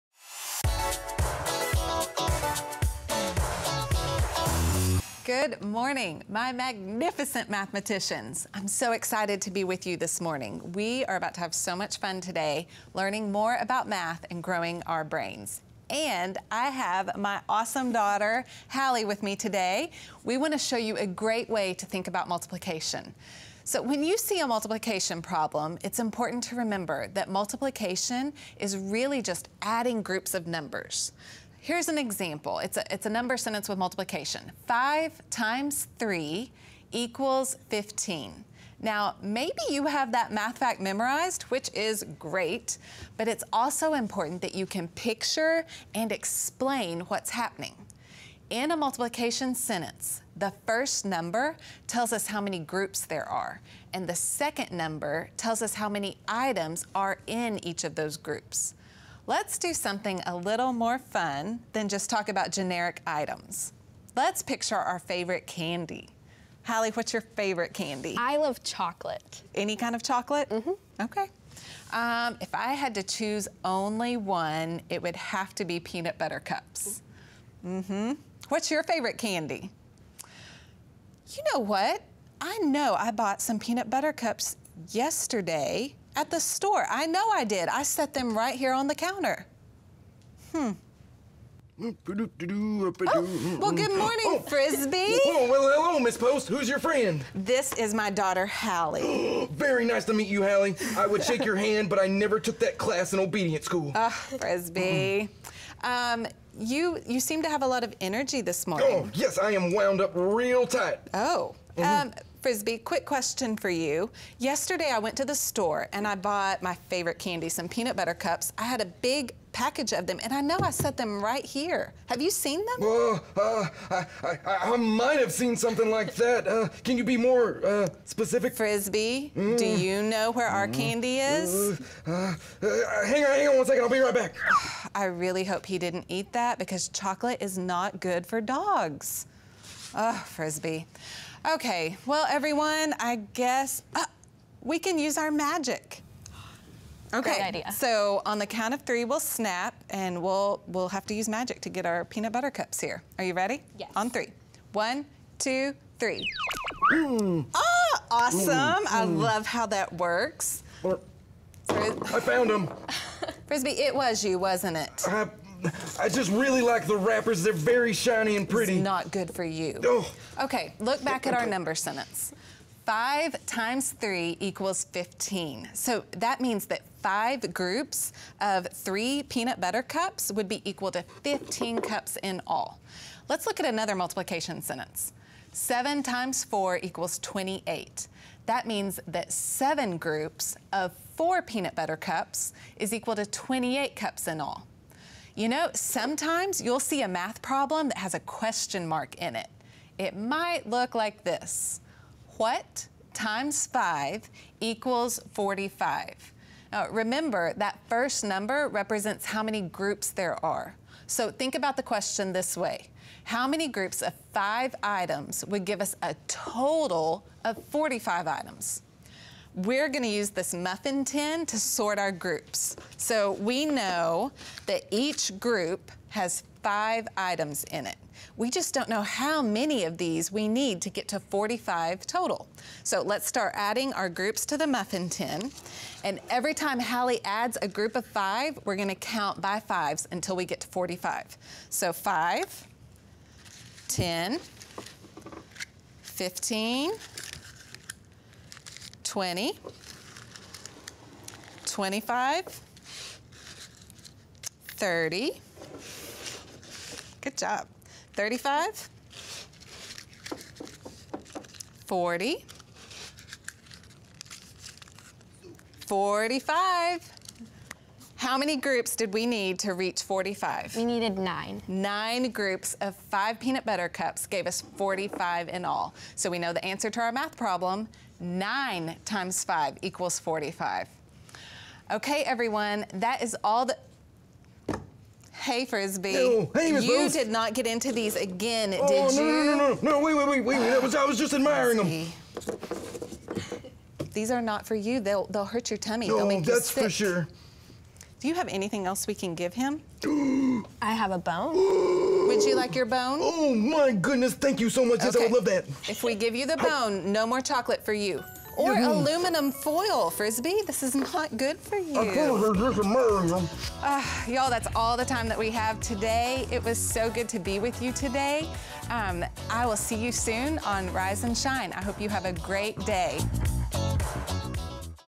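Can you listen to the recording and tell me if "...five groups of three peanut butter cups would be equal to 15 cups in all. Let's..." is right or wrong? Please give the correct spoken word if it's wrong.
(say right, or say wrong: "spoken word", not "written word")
right.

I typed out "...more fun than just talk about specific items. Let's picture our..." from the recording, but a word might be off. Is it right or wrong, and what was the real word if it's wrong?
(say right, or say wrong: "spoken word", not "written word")
wrong: "generic", not "specific".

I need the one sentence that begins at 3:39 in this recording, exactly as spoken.
we're gonna use this muffin tin to sort our groups.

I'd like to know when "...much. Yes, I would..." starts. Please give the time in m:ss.
5:04.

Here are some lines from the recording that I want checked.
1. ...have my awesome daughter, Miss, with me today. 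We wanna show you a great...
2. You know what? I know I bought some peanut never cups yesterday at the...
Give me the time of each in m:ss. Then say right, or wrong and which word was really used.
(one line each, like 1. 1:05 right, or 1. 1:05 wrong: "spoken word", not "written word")
1. 0:16 wrong: "Hallie", not "Miss"
2. 1:21 wrong: "butter", not "never".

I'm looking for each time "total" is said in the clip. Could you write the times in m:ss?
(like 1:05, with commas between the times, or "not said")
3:36, 3:52.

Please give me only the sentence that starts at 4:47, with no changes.
did not get into these again, oh, did no, you?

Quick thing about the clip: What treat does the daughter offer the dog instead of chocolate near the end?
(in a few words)
A bone.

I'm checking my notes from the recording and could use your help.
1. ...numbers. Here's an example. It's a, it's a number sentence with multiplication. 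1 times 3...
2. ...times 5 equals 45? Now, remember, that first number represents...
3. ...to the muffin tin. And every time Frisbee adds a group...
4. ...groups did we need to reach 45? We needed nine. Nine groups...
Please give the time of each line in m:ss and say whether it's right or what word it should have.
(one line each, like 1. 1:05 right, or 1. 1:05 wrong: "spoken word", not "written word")
1. 0:30 wrong: "5", not "1"
2. 3:23 right
3. 3:54 wrong: "Hallie", not "Frisbee"
4. 4:28 right.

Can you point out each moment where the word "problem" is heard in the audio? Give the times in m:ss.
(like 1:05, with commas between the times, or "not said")
0:25, 3:17, 4:37.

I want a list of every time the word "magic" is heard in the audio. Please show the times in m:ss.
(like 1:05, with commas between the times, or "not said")
2:25, 2:31.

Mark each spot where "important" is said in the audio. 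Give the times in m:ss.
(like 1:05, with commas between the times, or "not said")
0:25, 0:43.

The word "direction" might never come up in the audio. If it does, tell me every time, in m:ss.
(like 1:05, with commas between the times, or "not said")
not said.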